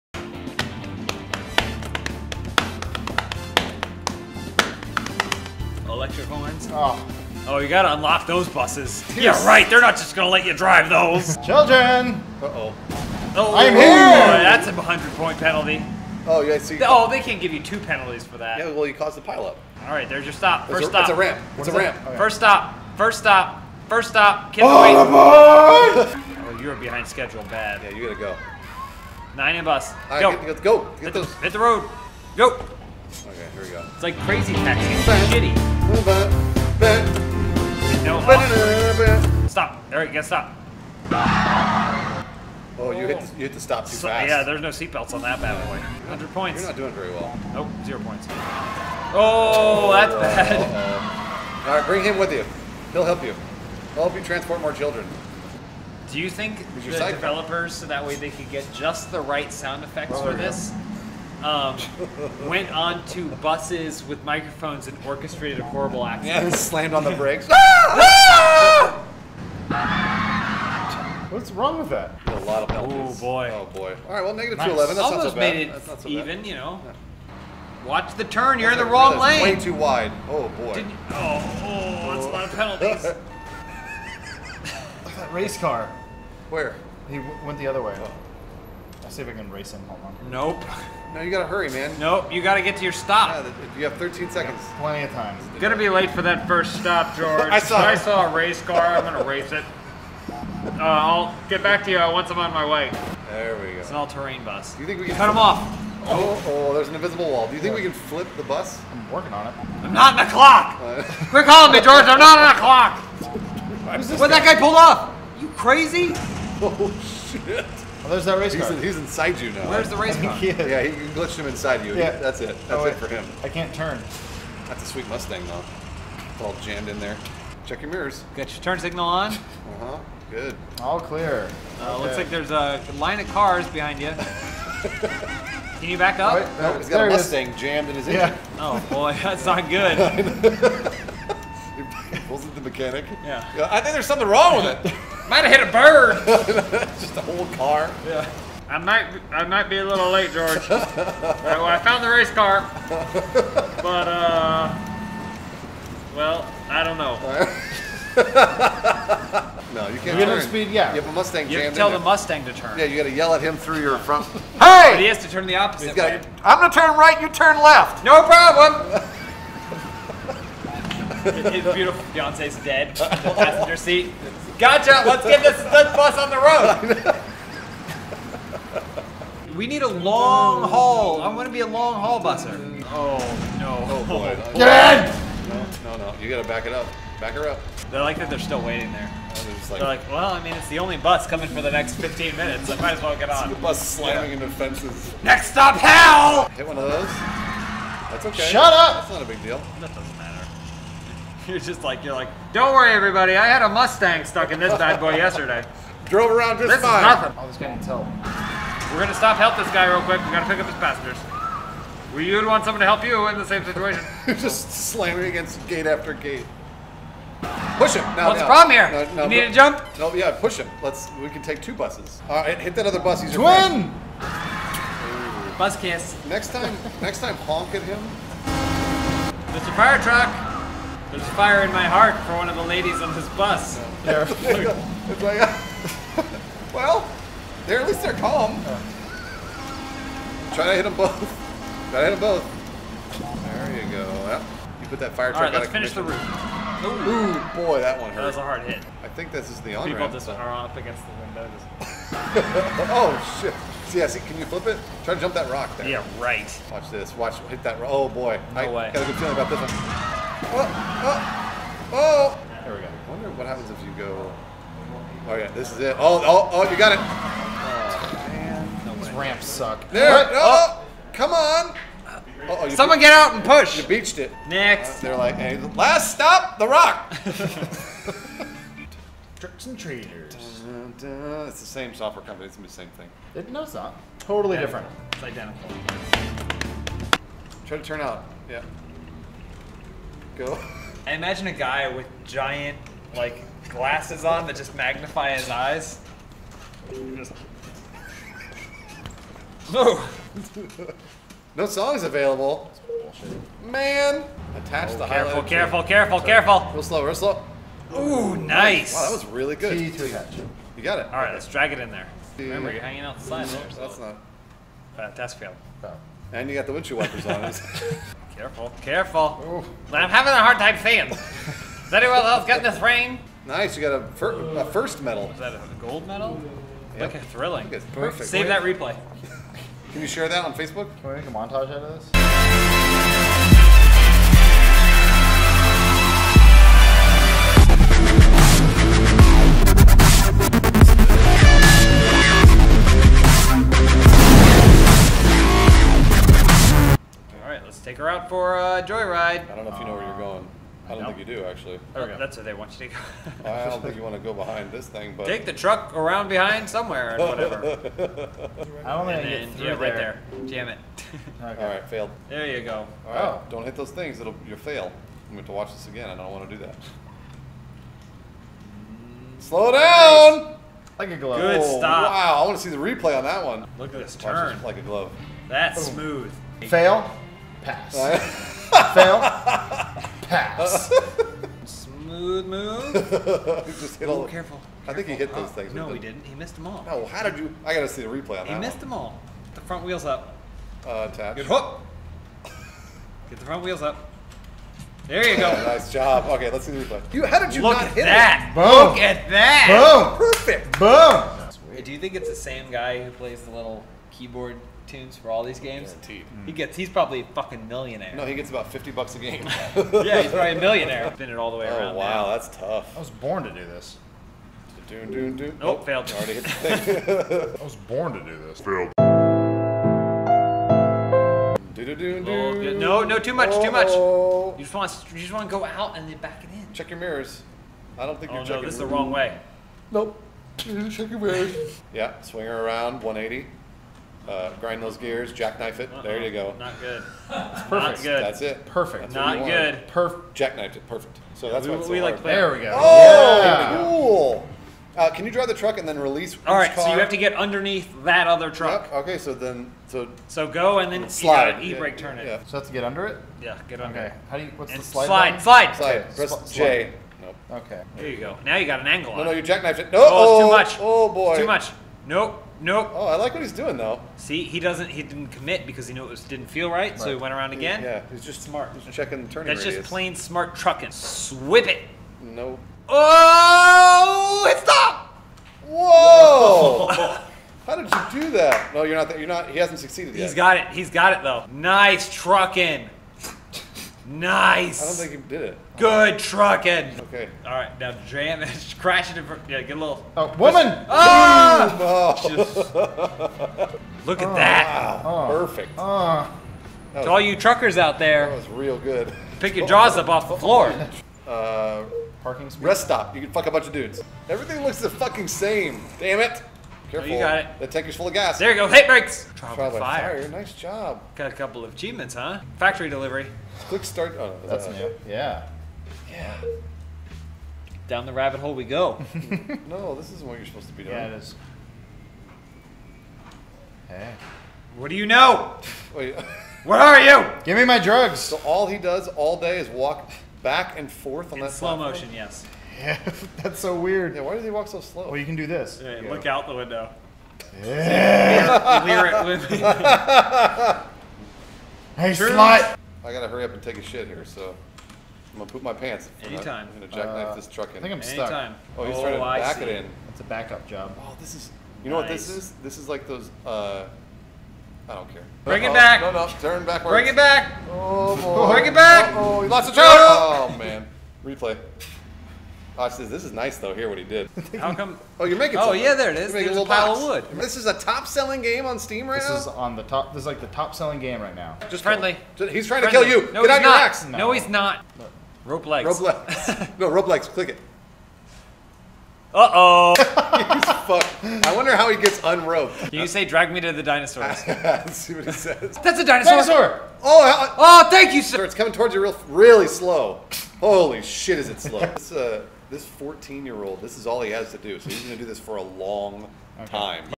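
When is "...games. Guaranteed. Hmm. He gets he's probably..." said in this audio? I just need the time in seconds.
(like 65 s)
405 s.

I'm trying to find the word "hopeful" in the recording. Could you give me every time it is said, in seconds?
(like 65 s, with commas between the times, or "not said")
not said.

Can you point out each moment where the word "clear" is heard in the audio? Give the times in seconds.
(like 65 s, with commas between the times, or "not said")
130 s.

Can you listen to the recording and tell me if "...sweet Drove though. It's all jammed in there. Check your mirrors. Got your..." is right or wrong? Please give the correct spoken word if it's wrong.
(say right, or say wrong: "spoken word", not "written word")
wrong: "Mustang", not "Drove".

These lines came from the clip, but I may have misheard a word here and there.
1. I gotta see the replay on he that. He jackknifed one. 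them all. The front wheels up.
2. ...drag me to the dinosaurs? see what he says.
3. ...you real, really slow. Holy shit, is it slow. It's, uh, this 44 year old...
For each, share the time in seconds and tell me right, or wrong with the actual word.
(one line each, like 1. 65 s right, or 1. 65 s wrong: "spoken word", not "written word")
1. 387 s wrong: "missed", not "jackknifed"
2. 583 s right
3. 588 s wrong: "14", not "44".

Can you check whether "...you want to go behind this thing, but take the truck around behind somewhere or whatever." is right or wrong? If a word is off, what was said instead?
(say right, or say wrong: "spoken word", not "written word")
right.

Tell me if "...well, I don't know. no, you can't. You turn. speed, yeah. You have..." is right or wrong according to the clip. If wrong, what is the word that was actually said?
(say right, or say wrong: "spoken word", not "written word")
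right.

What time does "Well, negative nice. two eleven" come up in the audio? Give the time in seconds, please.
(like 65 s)
74 s.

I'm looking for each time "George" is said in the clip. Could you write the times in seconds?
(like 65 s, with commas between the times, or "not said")
97 s, 111 s, 150 s.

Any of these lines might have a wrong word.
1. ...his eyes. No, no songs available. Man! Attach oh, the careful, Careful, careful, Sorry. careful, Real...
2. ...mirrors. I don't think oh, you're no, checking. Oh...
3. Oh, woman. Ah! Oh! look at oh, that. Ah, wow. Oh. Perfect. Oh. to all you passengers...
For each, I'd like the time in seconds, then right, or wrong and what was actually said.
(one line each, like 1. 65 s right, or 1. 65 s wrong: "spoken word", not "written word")
1. 295 s right
2. 426 s right
3. 490 s wrong: "truckers", not "passengers".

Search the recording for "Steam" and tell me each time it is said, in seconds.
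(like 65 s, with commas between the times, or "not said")
568 s.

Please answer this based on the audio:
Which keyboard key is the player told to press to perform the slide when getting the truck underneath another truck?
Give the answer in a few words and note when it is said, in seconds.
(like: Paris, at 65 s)
J, at 456 s.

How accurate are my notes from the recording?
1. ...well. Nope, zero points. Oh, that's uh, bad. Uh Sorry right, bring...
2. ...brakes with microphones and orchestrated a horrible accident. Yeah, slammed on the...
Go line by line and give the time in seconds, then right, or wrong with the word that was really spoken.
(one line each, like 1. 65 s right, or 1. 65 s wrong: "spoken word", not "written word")
1. 47 s wrong: "All", not "Sorry"
2. 63 s wrong: "buses", not "brakes".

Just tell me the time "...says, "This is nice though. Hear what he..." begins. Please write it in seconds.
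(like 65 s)
562 s.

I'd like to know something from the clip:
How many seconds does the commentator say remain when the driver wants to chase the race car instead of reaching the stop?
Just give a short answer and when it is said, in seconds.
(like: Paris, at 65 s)
13, at 93 s.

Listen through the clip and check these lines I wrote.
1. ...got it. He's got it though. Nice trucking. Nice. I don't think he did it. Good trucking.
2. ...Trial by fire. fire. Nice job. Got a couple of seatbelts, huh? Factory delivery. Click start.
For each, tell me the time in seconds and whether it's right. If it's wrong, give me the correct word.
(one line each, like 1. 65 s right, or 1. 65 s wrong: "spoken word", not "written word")
1. 480 s right
2. 509 s wrong: "achievements", not "seatbelts".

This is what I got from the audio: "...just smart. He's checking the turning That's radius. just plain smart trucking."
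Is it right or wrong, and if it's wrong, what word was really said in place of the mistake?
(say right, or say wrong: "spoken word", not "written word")
right.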